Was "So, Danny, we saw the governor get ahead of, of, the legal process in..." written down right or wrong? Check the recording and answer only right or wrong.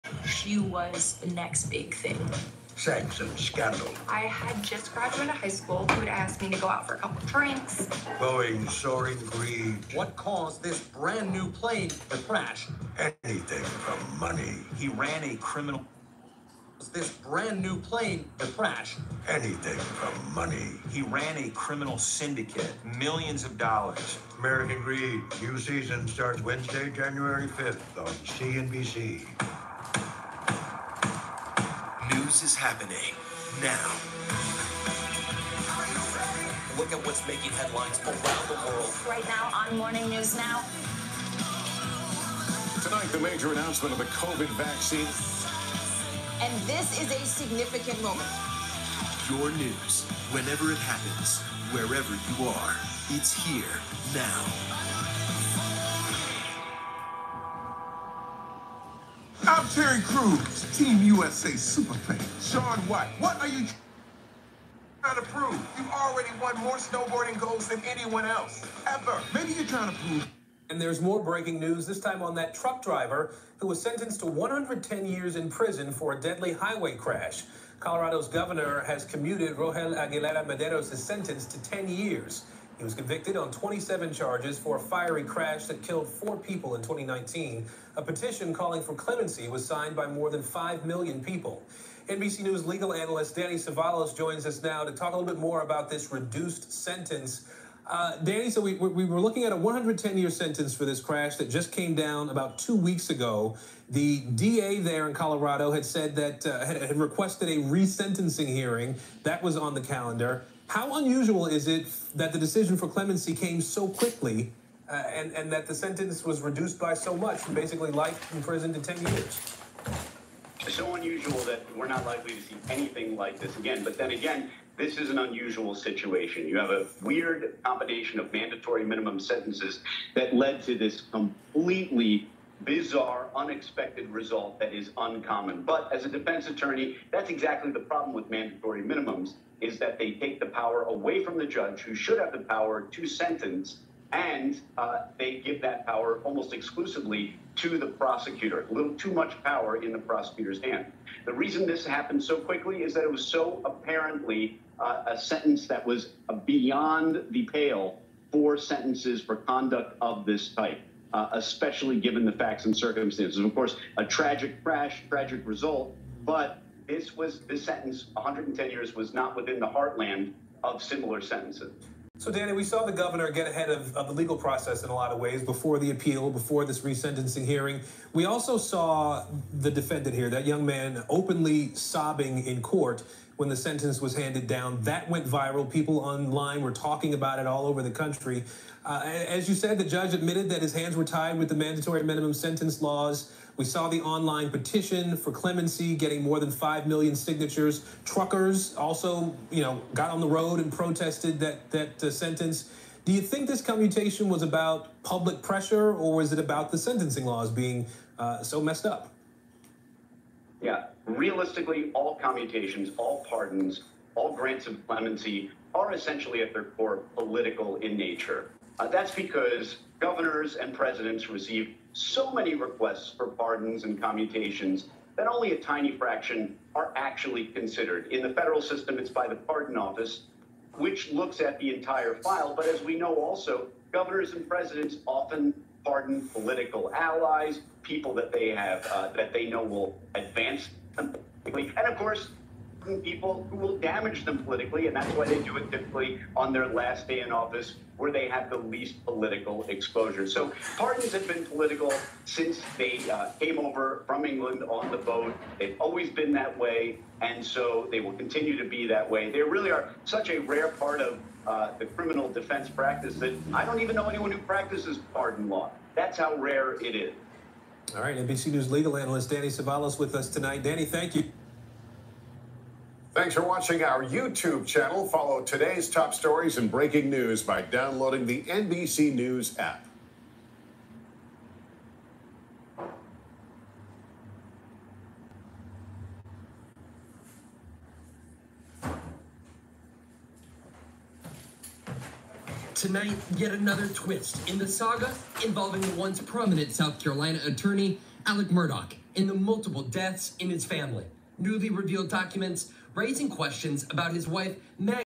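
right.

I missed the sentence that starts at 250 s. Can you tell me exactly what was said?
So pardons have been political since they uh, came over from England on the boat.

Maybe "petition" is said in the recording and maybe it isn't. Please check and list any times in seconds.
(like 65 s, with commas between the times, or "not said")
88 s, 194 s.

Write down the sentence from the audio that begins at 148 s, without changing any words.
A little too much power in the prosecutor's hand.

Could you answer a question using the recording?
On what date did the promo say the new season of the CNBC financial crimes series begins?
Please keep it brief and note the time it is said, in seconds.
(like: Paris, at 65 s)
Wednesday, January 5th, at 26 s.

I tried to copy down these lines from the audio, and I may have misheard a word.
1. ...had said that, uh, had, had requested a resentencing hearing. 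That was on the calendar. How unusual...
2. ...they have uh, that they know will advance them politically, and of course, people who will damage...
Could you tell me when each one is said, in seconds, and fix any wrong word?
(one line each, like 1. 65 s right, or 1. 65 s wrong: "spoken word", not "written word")
1. 105 s right
2. 238 s right.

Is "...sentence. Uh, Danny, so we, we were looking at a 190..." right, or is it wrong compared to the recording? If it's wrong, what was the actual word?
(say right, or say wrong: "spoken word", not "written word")
wrong: "110", not "190".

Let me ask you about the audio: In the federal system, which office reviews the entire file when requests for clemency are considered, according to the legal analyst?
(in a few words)
Pardon Office.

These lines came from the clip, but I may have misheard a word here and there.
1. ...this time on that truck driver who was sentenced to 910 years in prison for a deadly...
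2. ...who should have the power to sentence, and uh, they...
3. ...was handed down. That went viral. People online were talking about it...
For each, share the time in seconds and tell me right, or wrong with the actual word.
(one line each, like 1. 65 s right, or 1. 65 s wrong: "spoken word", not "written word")
1. 71 s wrong: "110", not "910"
2. 141 s right
3. 183 s right.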